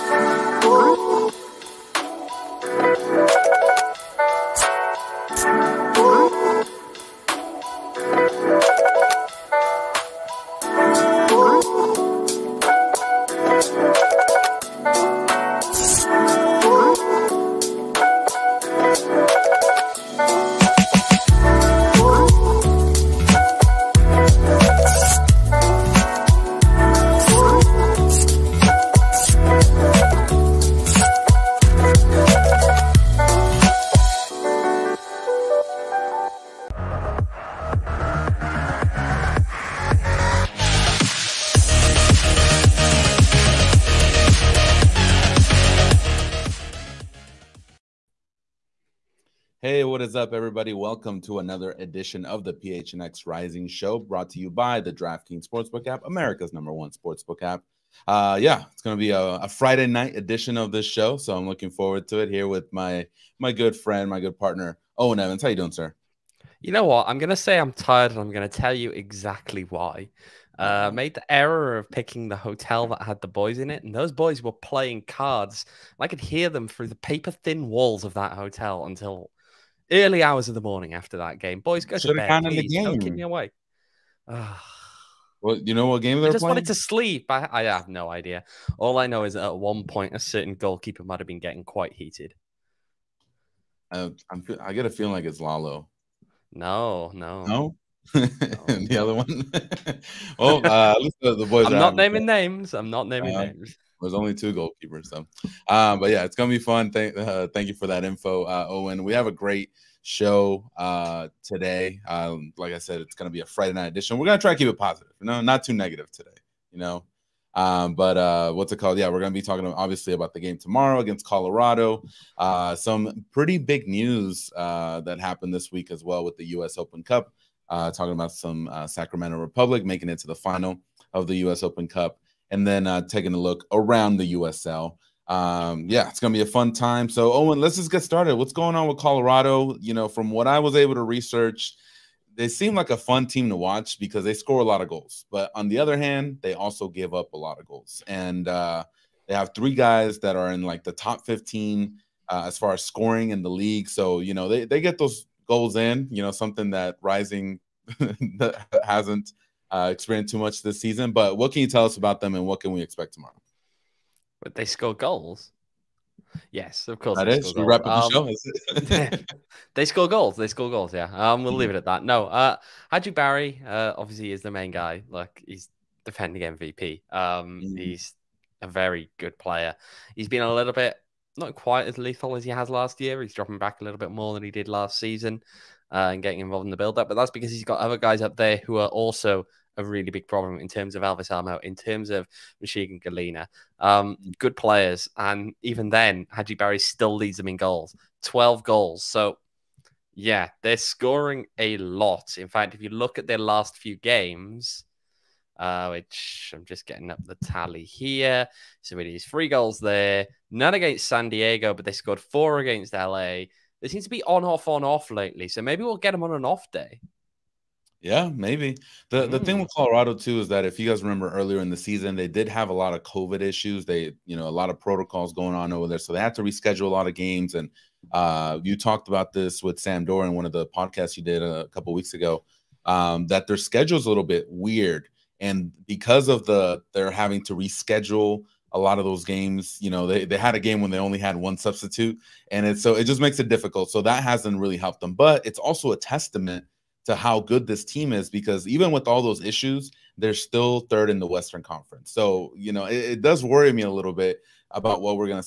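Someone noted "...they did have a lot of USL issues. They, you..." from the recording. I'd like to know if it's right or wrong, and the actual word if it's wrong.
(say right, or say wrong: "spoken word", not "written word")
wrong: "COVID", not "USL".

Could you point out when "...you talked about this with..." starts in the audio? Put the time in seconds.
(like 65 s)
228 s.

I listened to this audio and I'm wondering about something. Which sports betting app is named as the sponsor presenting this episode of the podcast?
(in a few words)
DraftKings Sportsbook.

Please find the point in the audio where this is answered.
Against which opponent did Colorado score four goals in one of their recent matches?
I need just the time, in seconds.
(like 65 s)
212 s.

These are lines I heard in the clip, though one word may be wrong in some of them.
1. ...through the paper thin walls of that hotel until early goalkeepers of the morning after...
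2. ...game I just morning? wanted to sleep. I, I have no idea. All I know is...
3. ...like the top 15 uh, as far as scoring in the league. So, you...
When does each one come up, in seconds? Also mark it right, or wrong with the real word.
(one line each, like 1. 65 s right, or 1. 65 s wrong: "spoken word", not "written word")
1. 76 s wrong: "hours", not "goalkeepers"
2. 86 s wrong: "playing", not "morning"
3. 150 s right.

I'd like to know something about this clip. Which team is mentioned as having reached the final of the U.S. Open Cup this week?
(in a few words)
Sacramento Republic.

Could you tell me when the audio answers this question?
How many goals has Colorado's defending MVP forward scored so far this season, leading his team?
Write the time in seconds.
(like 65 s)
198 s.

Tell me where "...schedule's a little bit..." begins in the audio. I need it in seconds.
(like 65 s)
233 s.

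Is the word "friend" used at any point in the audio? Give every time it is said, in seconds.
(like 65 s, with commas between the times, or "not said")
63 s.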